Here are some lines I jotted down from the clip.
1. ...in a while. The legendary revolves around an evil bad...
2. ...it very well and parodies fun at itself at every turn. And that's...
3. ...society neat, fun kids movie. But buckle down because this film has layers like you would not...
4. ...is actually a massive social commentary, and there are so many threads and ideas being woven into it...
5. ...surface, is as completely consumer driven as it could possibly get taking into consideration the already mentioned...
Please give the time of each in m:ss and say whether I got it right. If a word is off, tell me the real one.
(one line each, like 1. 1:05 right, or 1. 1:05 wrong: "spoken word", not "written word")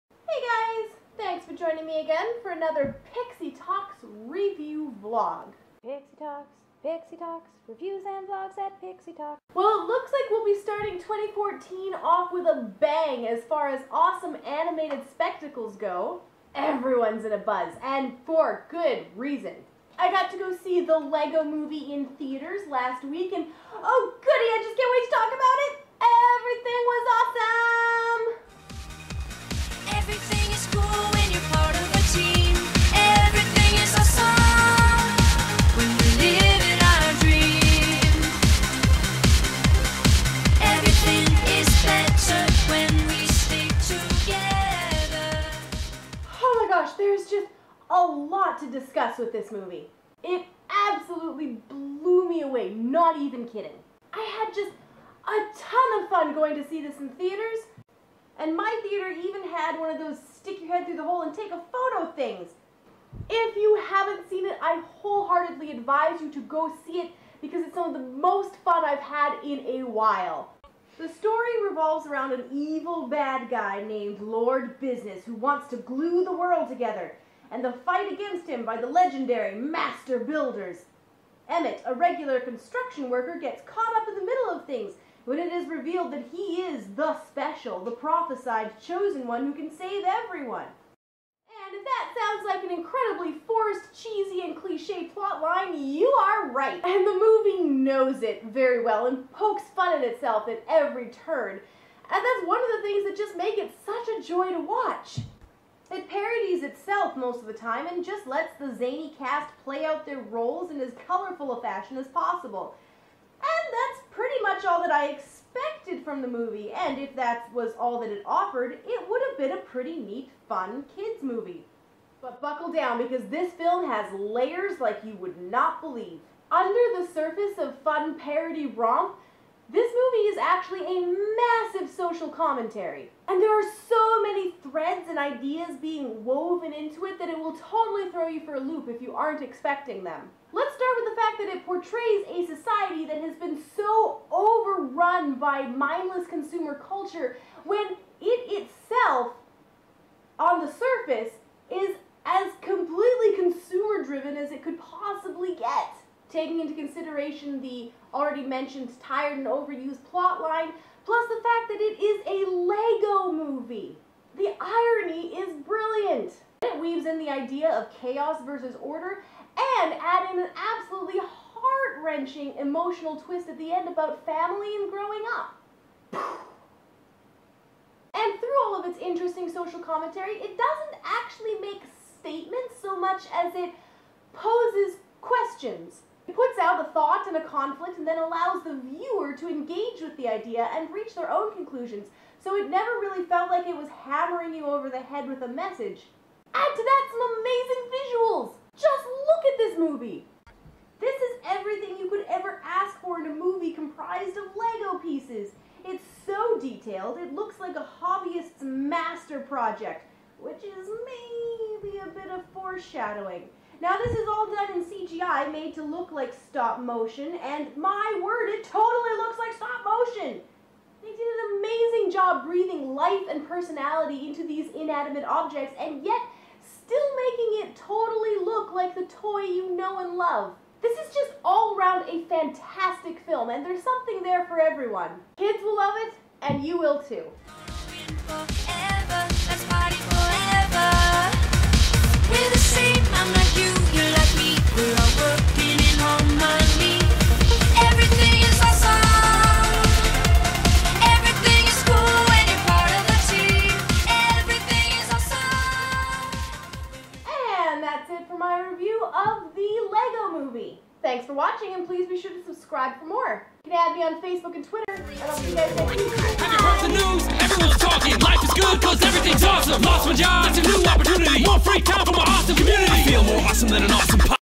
1. 1:09 wrong: "story", not "legendary"
2. 1:38 wrong: "pokes", not "parodies"
3. 1:59 wrong: "pretty", not "society"
4. 2:10 right
5. 2:30 right.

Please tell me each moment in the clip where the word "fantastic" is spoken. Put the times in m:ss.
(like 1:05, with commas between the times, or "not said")
3:52.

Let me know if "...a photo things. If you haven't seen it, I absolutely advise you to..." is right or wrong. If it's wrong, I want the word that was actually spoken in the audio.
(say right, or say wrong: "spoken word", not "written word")
wrong: "wholeheartedly", not "absolutely".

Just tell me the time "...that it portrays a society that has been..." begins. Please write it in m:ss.
2:21.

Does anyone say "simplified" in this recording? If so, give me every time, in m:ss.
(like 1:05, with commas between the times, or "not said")
not said.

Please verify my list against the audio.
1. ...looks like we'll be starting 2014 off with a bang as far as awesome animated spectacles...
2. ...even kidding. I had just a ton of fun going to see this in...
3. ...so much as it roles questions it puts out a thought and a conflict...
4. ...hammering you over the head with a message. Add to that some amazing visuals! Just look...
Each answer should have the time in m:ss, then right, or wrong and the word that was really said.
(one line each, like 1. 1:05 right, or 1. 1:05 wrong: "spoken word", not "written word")
1. 0:09 right
2. 0:53 right
3. 3:02 wrong: "poses", not "roles"
4. 3:14 right.